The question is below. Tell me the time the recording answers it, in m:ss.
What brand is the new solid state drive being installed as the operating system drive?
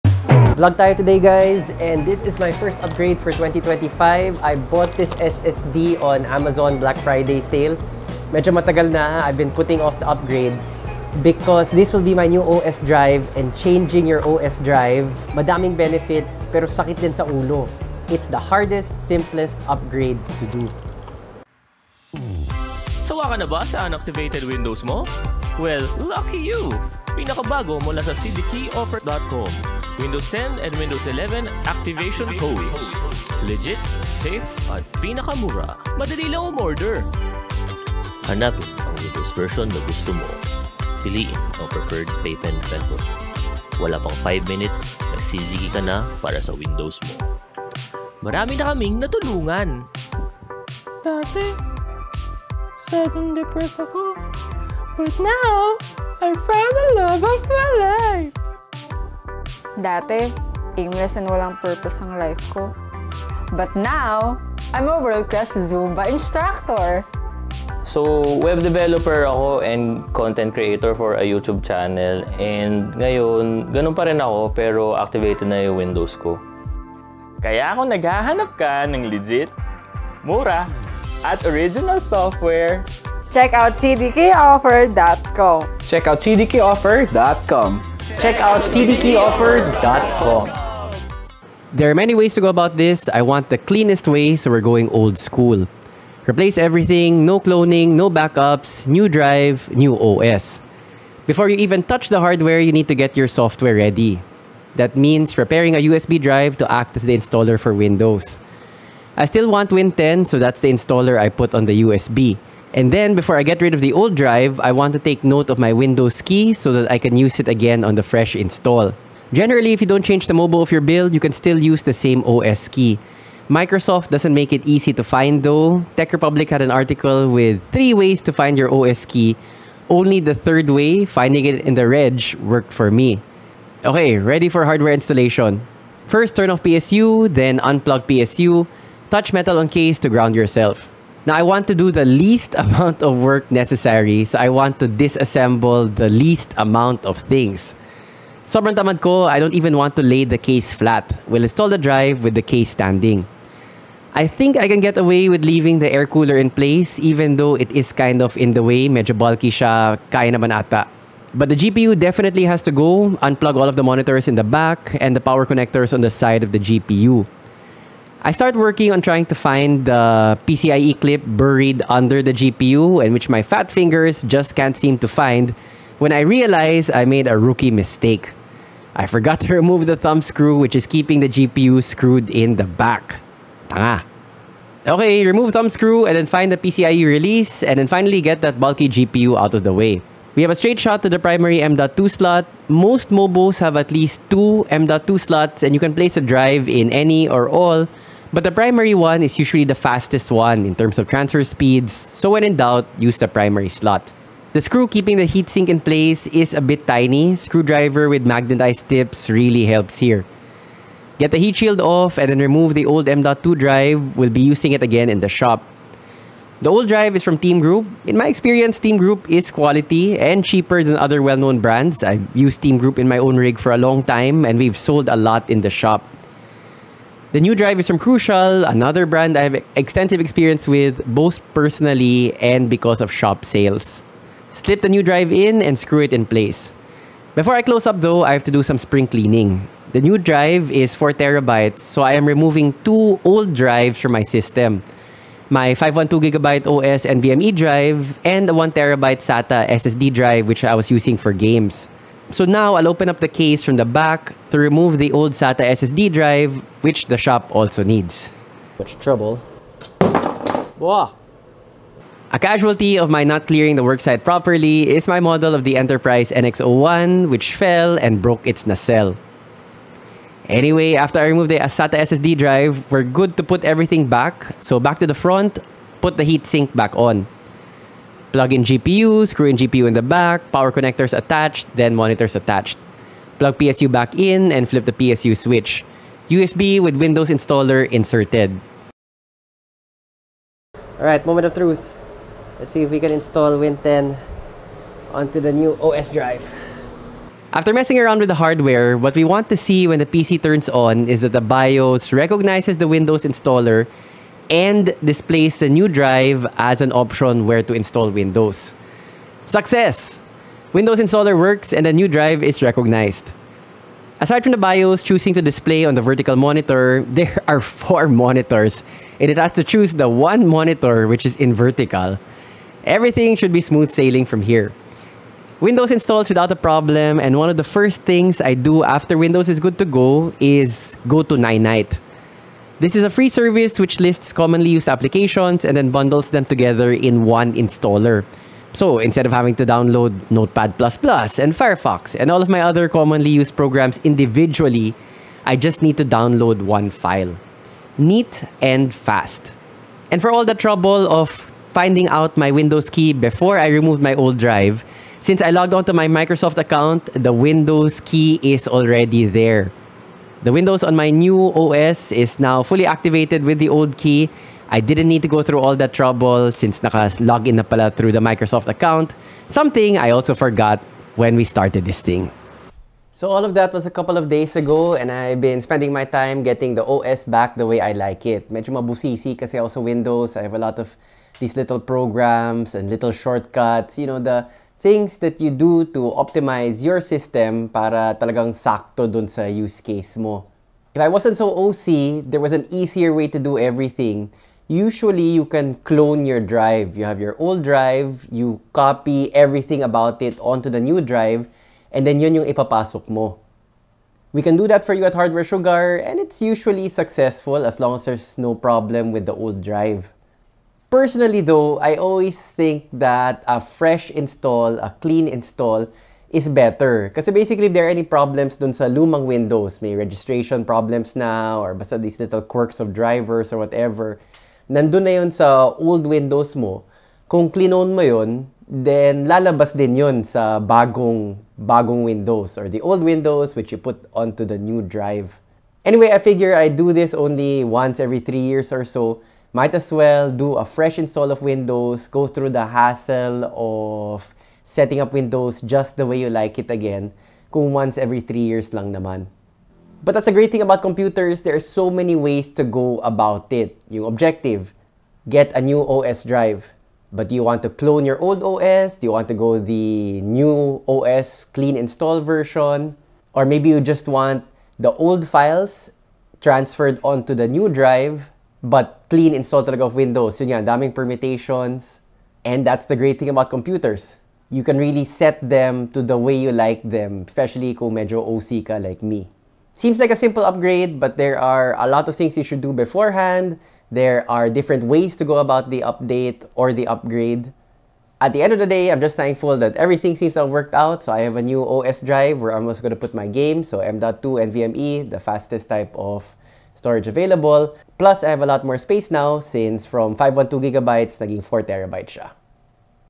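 3:47.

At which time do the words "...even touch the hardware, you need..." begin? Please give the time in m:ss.
1:41.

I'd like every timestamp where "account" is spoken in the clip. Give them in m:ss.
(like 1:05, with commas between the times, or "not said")
5:56, 6:08.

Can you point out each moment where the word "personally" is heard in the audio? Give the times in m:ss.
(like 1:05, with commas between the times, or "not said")
3:51, 6:50.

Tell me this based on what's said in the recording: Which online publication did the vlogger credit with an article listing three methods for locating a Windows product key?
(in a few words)
TechRepublic.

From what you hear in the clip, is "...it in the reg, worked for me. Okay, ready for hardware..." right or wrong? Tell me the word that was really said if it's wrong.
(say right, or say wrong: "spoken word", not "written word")
right.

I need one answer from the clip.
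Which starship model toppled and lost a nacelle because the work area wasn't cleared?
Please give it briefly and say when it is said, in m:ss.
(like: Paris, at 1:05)
Enterprise NX01, at 4:25.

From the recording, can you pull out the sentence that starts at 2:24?
So I want to disassemble the least amount of things.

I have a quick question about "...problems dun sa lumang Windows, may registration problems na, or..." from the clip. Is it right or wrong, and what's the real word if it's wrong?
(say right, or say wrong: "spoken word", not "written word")
right.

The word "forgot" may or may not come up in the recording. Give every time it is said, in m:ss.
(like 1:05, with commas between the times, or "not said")
2:59, 6:10.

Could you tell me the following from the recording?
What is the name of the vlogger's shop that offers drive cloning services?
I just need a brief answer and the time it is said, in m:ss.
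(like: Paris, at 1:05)
Hardware Sugar, at 6:45.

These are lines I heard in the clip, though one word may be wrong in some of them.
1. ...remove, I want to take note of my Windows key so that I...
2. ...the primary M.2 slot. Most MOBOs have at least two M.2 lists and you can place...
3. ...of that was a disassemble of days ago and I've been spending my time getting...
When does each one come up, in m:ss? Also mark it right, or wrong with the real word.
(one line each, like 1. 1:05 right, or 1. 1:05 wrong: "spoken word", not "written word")
1. 1:54 wrong: "drive", not "remove"
2. 3:11 wrong: "slots", not "lists"
3. 6:13 wrong: "couple", not "disassemble".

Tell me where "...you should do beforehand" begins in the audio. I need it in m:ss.
8:02.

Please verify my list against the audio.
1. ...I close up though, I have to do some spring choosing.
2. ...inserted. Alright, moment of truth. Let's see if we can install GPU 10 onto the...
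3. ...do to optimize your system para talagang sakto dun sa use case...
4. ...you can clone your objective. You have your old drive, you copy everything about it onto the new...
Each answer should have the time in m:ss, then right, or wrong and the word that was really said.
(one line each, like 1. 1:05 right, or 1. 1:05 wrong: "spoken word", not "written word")
1. 3:57 wrong: "cleaning", not "choosing"
2. 4:47 wrong: "Win", not "GPU"
3. 6:25 right
4. 6:35 wrong: "drive", not "objective".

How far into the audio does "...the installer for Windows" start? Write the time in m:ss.
1:47.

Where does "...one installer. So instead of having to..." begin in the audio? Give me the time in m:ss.
5:37.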